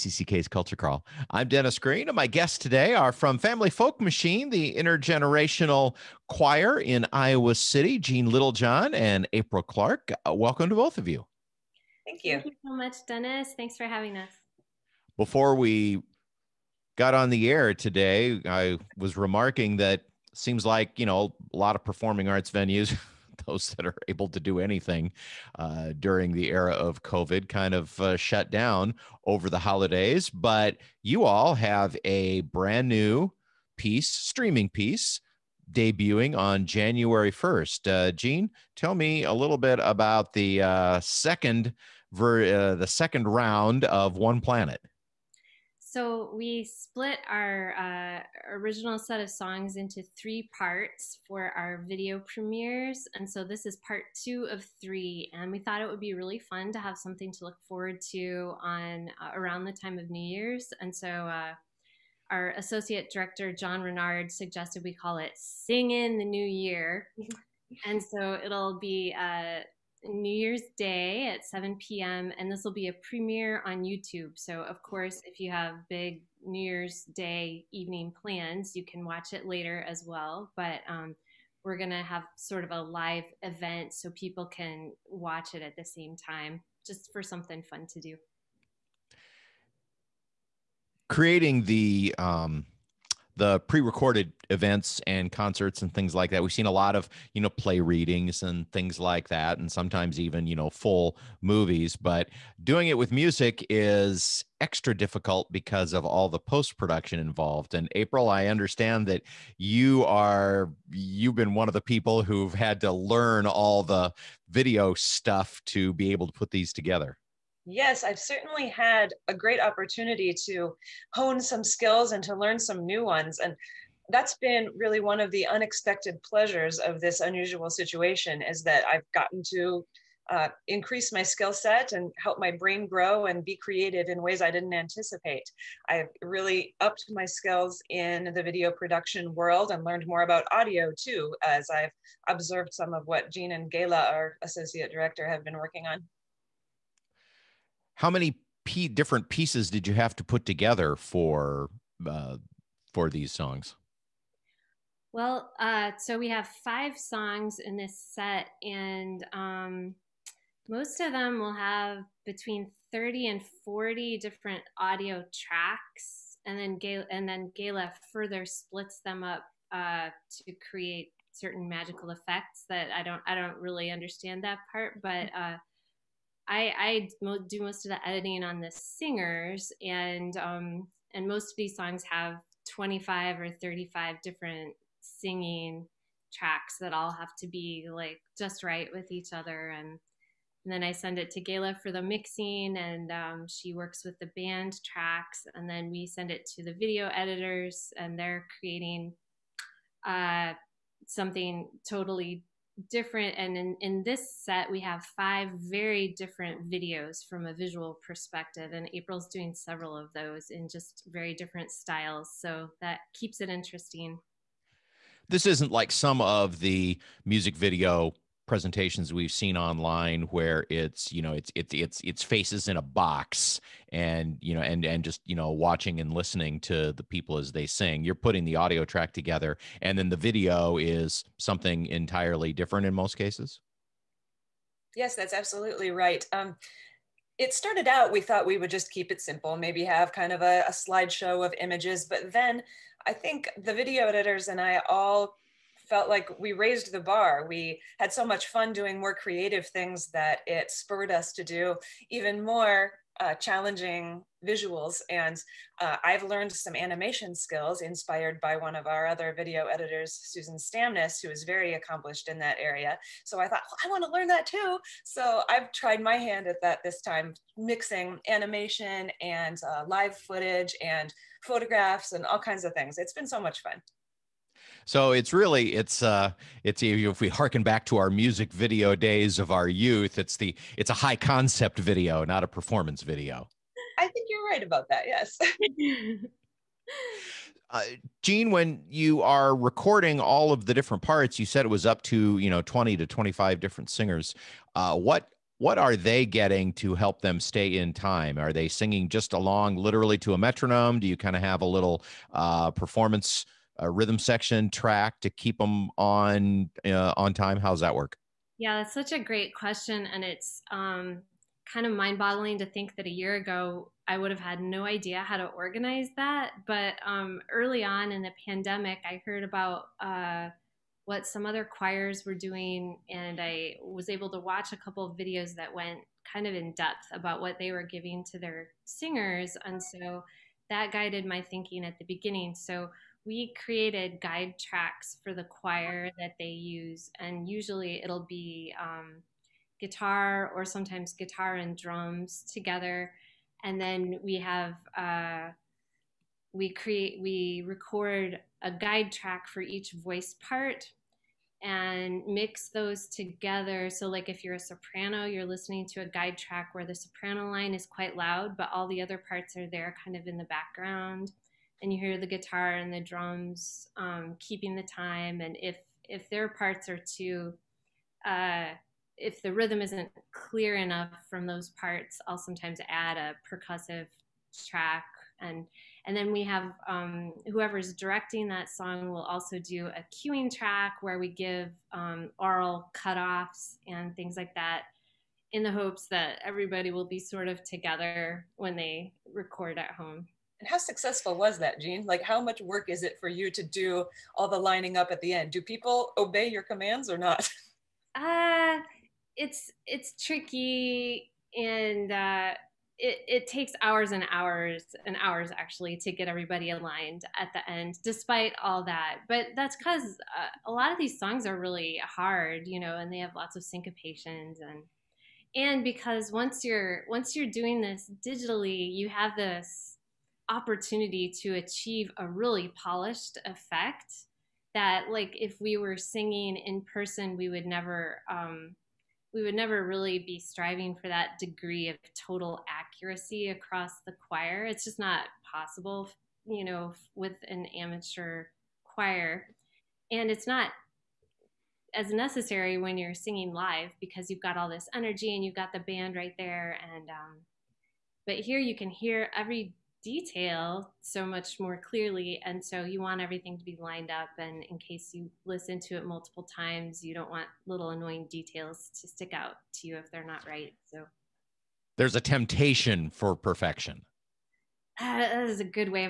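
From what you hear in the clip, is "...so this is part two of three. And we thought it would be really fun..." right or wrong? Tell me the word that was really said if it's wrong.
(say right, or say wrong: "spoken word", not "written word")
right.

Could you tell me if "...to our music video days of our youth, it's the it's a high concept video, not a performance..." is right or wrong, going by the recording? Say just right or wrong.
right.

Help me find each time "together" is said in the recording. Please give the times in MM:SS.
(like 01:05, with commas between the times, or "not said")
01:56, 02:30, 03:49, 05:42, 05:53, 06:27.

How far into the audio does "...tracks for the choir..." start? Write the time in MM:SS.
05:34.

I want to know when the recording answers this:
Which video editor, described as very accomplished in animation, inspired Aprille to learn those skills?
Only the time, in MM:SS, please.
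04:20.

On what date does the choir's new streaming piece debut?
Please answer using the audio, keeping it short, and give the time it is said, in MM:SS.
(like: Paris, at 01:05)
January 1st, at 00:36.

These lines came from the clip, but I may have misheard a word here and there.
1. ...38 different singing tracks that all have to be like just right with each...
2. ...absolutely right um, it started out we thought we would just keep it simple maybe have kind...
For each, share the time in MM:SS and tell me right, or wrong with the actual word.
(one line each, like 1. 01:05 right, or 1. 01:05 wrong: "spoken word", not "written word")
1. 03:03 wrong: "35", not "38"
2. 03:55 right.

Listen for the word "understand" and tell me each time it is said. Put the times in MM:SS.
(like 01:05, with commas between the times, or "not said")
01:48, 02:53.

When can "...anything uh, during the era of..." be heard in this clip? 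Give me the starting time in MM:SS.
00:24.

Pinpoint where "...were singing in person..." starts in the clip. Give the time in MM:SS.
07:05.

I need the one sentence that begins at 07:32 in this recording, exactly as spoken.
And so you want everything to be lined up.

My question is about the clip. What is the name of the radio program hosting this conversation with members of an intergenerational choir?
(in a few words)
Culture Crawl.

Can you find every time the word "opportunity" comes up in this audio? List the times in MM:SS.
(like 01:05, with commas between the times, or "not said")
01:59, 07:00.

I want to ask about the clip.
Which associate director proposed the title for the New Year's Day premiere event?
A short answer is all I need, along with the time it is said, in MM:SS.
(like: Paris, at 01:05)
John Renard, at 01:03.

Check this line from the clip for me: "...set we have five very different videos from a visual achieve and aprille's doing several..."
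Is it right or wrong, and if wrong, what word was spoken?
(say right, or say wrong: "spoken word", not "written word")
wrong: "perspective", not "achieve".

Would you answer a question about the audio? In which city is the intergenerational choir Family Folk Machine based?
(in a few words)
Iowa City.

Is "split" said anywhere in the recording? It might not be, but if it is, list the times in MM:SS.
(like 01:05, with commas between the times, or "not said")
00:46, 02:48.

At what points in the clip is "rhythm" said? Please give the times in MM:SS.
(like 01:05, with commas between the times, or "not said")
05:03, 06:09.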